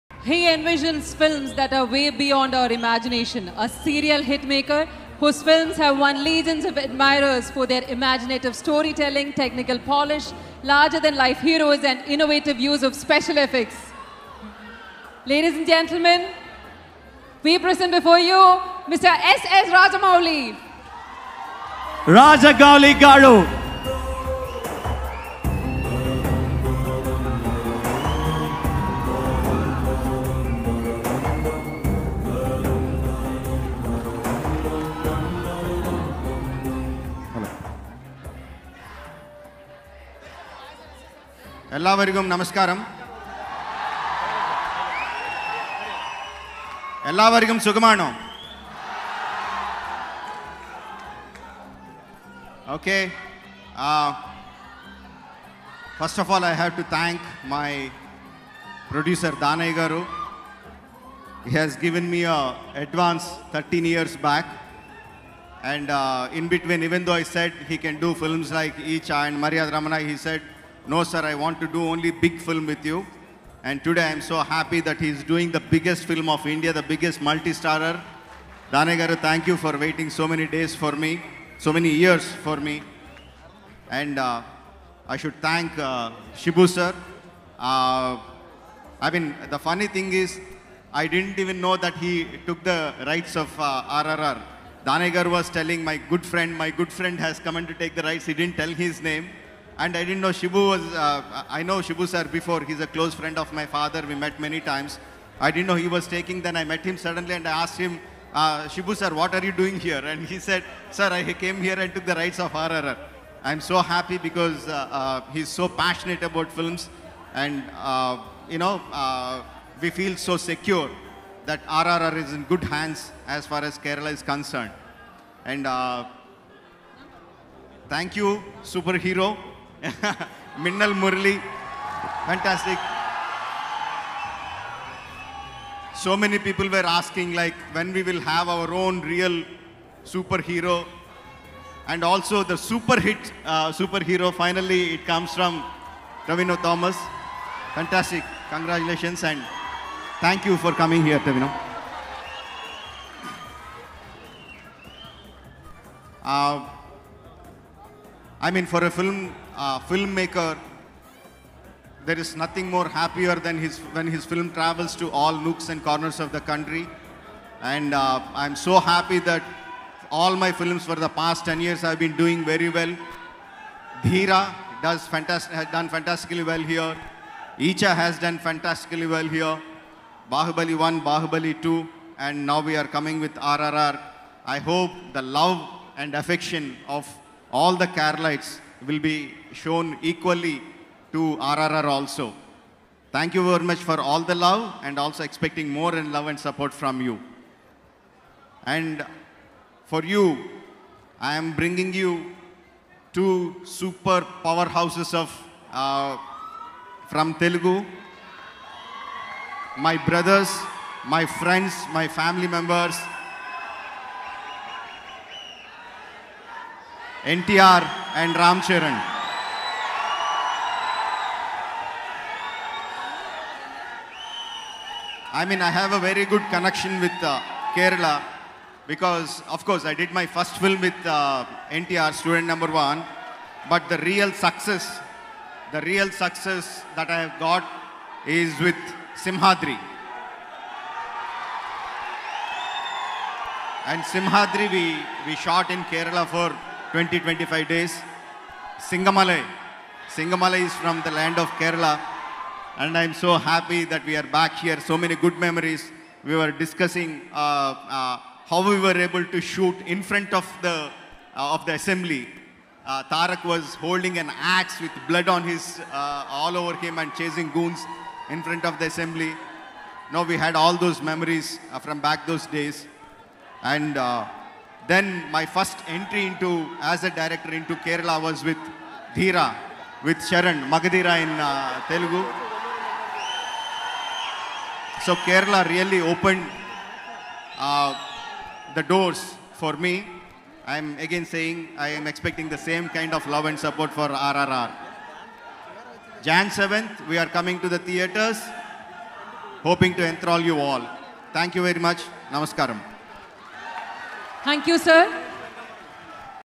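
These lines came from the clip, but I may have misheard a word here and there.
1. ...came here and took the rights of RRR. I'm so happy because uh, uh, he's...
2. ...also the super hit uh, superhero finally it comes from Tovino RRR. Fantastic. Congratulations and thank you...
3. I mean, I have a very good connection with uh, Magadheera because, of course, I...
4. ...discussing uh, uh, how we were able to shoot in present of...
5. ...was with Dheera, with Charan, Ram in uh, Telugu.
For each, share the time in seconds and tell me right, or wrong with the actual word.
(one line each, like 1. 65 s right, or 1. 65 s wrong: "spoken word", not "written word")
1. 111 s right
2. 142 s wrong: "Thomas", not "RRR"
3. 225 s wrong: "Kerala", not "Magadheera"
4. 256 s wrong: "front", not "present"
5. 278 s wrong: "Magadheera", not "Ram".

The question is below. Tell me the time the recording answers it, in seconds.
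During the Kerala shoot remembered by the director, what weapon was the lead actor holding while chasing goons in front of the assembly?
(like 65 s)
264 s.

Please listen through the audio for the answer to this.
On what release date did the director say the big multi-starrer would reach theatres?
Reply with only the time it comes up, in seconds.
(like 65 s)
296 s.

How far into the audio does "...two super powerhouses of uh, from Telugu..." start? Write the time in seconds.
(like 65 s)
203 s.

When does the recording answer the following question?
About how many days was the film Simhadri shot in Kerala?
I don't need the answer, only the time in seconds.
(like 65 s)
246 s.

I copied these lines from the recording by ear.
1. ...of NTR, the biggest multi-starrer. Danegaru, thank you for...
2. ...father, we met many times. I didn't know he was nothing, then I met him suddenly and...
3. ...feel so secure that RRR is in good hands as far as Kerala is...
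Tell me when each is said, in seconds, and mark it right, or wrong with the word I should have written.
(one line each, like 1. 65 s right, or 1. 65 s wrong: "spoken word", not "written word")
1. 76 s wrong: "India", not "NTR"
2. 103 s wrong: "taking", not "nothing"
3. 119 s right.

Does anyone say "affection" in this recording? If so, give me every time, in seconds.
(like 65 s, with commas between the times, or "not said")
186 s.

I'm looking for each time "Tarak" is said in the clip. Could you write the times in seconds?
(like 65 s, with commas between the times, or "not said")
263 s.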